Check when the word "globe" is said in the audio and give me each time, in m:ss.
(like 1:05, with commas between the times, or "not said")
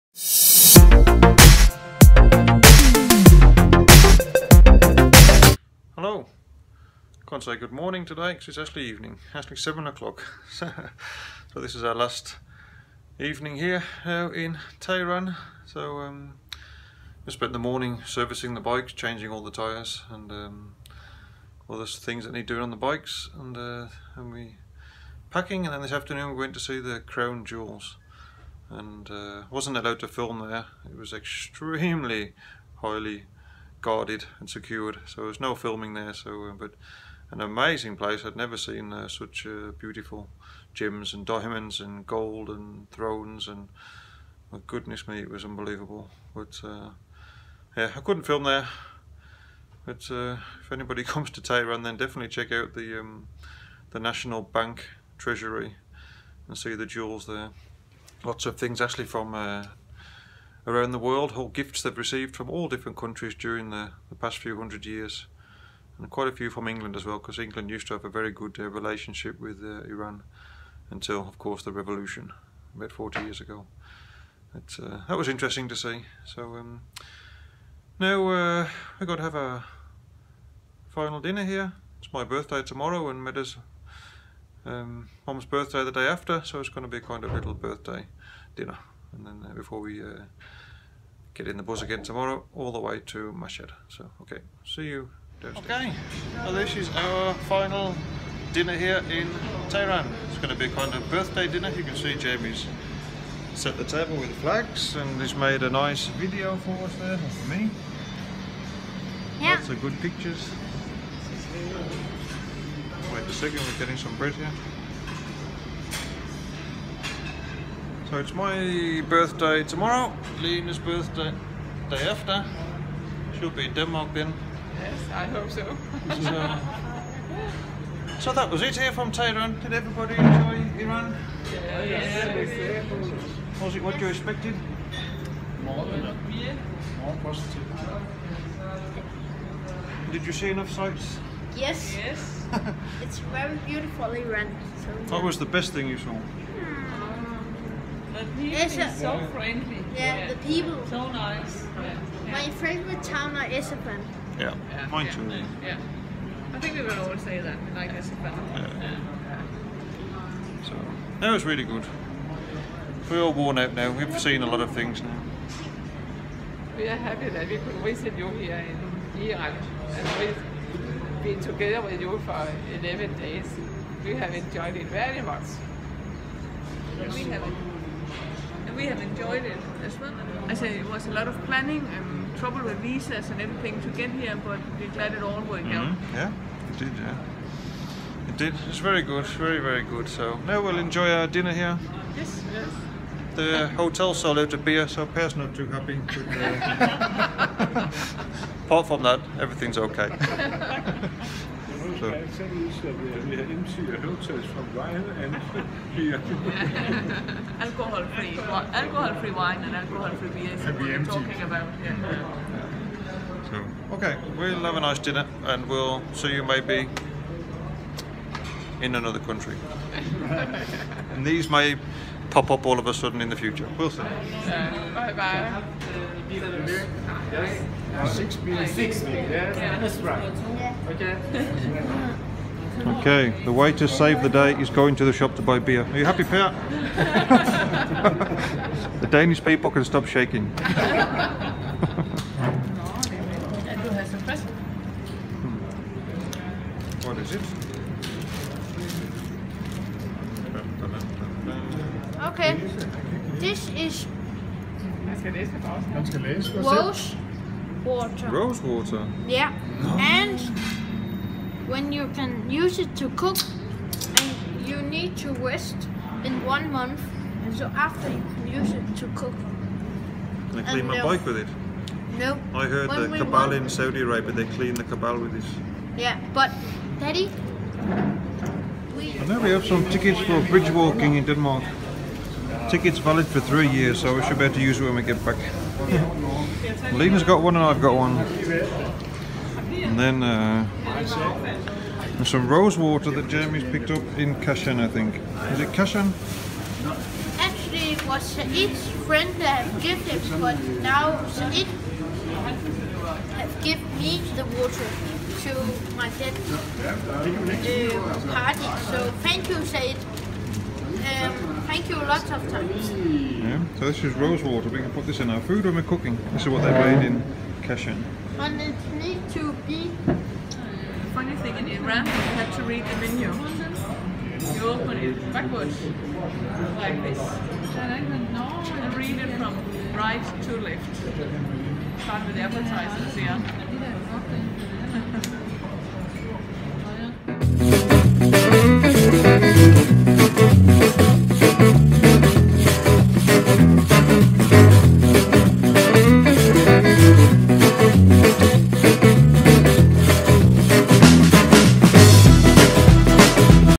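not said.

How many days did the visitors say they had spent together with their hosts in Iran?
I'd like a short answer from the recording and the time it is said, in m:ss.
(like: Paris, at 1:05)
11, at 2:52.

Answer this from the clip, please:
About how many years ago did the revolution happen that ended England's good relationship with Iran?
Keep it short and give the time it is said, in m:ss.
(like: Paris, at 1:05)
40, at 1:12.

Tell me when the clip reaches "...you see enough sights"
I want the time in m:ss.
2:20.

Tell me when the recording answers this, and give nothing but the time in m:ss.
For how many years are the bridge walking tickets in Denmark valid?
4:43.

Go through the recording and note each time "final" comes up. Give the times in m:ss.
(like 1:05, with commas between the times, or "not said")
1:20, 1:37.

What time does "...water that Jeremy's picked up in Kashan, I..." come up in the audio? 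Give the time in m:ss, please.
4:52.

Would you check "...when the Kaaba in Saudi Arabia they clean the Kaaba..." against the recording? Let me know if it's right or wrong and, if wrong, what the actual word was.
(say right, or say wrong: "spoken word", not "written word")
right.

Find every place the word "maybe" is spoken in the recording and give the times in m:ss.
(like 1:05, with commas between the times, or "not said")
3:36.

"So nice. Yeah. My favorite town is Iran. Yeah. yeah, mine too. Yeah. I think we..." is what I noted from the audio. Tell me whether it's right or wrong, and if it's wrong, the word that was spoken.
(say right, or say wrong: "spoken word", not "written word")
wrong: "Isfahan", not "Iran".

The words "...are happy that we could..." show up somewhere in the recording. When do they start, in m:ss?
2:46.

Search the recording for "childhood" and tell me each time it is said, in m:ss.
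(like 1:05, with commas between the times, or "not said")
not said.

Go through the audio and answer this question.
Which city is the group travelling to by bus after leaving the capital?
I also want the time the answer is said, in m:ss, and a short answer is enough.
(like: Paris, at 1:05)
Mashhad, at 1:33.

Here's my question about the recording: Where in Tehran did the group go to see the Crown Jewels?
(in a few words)
National Bank Treasury.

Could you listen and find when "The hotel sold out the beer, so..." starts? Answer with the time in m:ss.
3:13.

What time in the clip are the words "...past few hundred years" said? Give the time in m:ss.
1:04.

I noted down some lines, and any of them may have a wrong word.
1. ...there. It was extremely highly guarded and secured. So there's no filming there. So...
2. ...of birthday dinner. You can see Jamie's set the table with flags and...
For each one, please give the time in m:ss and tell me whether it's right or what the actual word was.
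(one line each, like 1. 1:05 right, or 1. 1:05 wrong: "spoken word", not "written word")
1. 0:30 right
2. 1:40 right.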